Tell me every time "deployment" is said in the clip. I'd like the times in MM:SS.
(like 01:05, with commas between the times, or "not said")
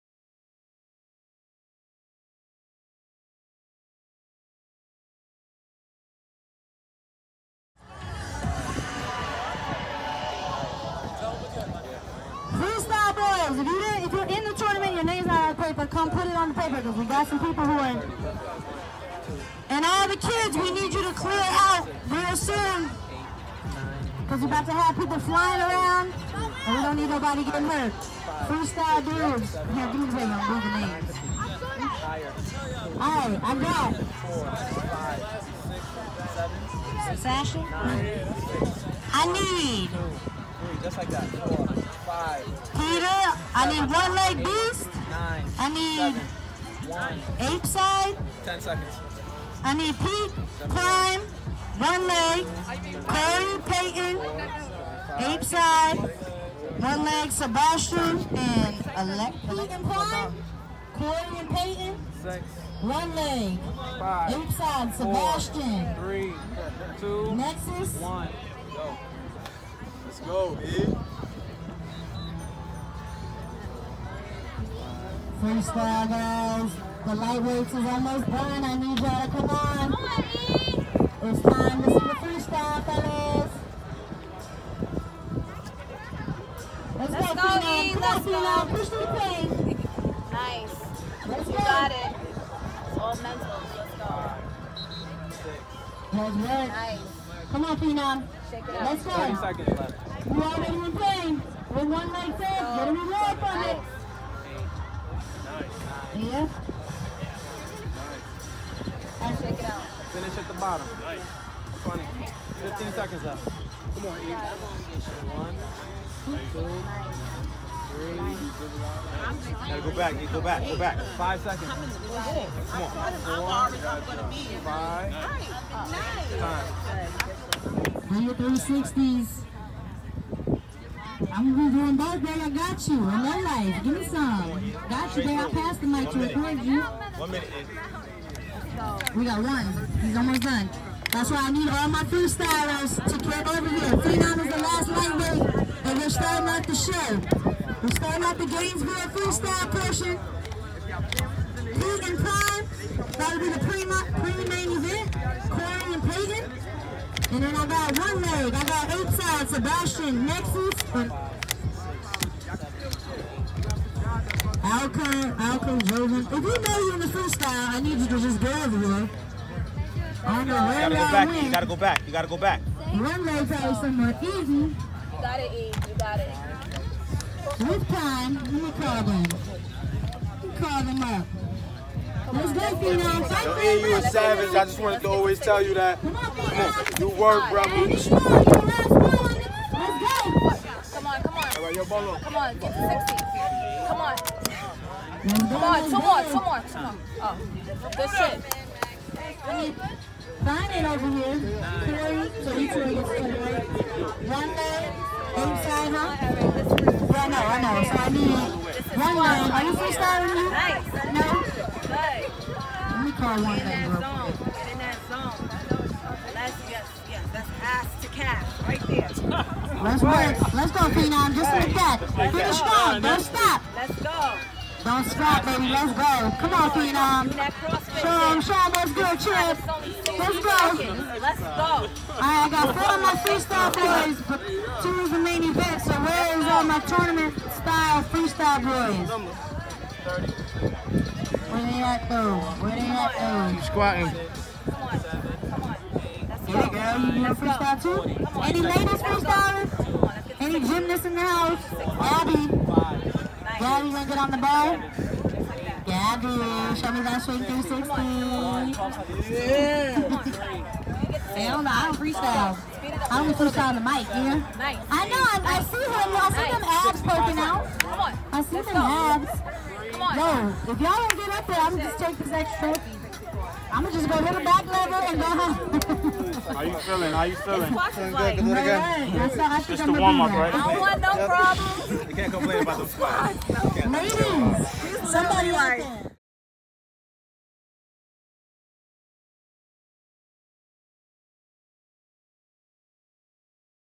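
not said.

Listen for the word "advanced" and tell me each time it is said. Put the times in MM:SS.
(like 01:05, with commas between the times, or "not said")
not said.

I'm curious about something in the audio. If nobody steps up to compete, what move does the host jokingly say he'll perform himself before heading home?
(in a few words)
back lever.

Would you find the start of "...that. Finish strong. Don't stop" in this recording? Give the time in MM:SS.
03:41.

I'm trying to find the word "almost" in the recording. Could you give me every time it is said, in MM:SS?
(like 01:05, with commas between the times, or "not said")
01:17, 02:20.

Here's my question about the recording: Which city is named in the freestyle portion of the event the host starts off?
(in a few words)
Gainesville.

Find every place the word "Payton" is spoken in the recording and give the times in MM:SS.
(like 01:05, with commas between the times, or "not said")
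00:53, 01:01.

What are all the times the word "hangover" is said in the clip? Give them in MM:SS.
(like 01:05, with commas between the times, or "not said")
not said.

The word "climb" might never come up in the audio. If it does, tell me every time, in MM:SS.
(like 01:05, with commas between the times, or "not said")
00:50, 00:59.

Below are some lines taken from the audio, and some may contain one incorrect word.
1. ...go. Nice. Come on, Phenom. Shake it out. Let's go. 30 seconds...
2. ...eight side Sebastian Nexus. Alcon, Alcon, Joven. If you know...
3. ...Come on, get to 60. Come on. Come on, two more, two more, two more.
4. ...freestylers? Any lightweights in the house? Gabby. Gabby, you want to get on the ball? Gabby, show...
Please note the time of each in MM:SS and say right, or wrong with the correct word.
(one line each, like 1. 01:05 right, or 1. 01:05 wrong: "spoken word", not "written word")
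1. 01:33 right
2. 02:38 right
3. 03:12 right
4. 04:09 wrong: "gymnasts", not "lightweights".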